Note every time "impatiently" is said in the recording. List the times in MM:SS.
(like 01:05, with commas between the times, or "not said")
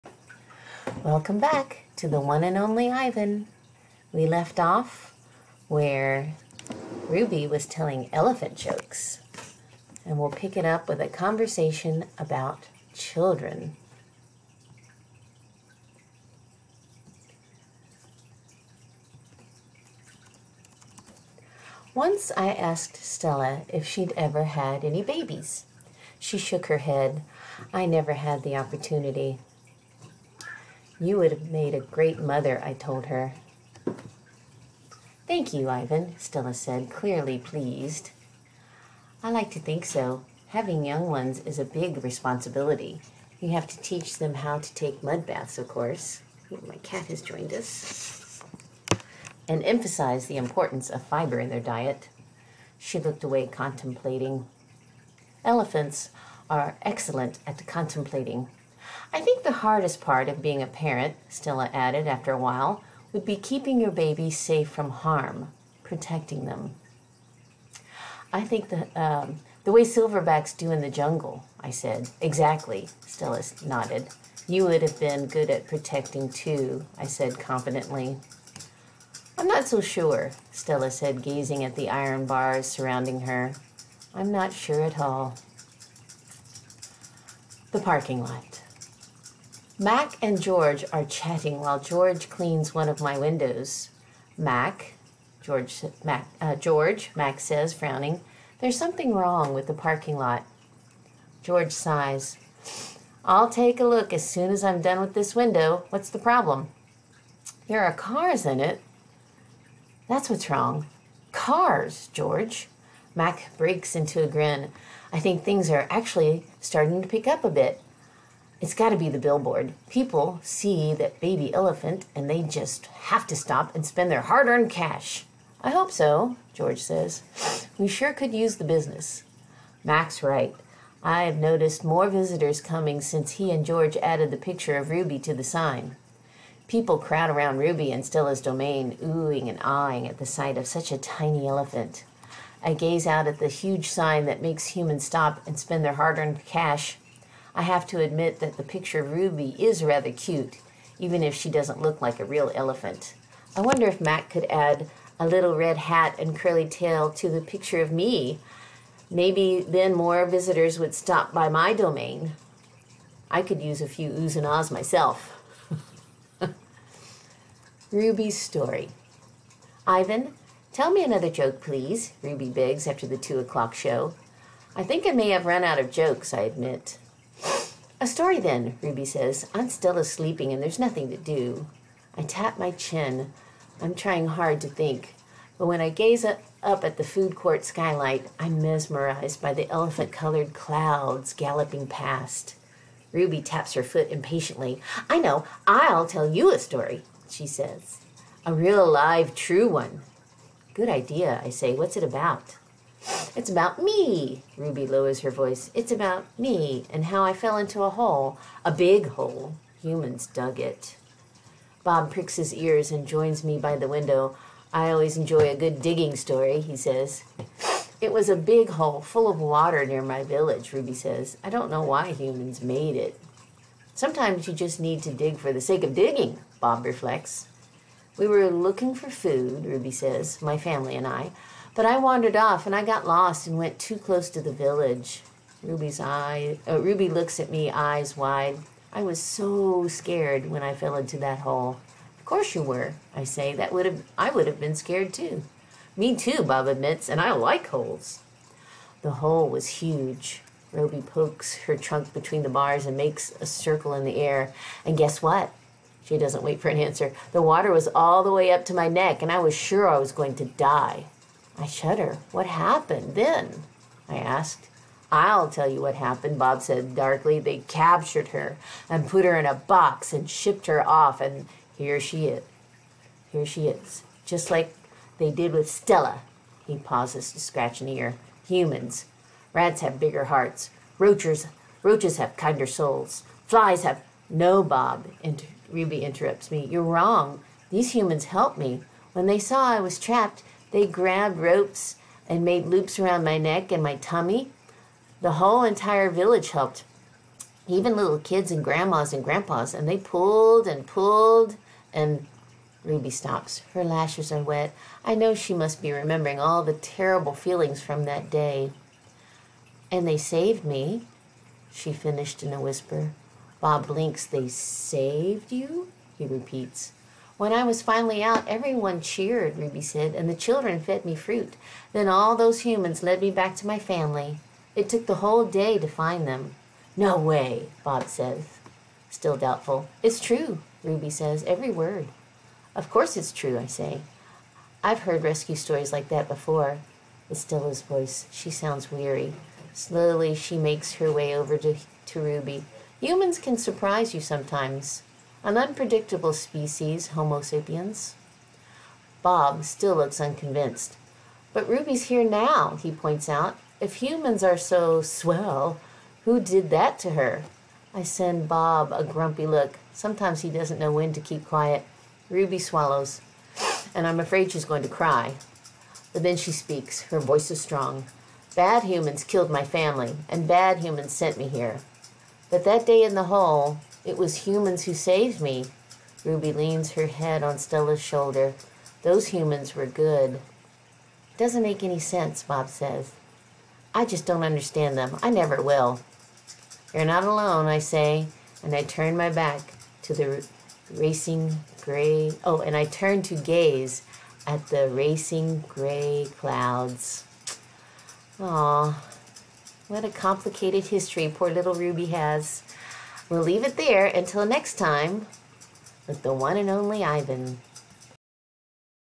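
03:14.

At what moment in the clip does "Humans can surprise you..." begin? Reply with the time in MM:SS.
05:42.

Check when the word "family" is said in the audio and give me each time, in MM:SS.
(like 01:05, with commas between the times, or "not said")
03:50, 05:23, 06:09.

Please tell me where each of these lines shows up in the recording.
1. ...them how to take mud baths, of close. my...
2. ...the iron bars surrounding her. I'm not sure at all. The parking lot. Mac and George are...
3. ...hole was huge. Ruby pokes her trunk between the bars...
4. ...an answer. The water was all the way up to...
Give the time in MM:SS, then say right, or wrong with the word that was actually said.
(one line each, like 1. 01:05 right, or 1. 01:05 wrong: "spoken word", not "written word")
1. 00:44 wrong: "course", not "close"
2. 01:21 right
3. 04:09 right
4. 04:16 right.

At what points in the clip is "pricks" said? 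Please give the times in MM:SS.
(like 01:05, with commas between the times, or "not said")
03:32.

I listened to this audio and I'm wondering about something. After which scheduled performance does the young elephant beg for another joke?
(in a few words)
two o'clock show.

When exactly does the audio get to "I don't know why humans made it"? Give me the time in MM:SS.
03:41.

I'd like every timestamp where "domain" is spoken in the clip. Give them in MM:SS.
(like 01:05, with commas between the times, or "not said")
02:18, 02:41.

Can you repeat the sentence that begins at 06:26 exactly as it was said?
You're not alone, I say, and I turn my back to the racing gray.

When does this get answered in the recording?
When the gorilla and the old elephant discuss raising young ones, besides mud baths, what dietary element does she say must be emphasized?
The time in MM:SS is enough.
00:51.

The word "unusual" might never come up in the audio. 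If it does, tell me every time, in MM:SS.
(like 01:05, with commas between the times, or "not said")
not said.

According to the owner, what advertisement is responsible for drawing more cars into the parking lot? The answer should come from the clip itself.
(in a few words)
the billboard.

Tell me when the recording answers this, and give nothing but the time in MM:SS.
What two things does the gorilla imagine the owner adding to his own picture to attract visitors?
02:35.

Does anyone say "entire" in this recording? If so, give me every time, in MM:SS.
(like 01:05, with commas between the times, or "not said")
04:55.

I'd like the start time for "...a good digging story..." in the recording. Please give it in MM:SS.
03:35.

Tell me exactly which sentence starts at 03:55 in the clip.
Ruby's eye, uh, Ruby looks at me, eyes wide.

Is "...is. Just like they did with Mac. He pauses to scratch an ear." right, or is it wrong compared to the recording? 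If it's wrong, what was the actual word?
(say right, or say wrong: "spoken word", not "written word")
wrong: "Stella", not "Mac".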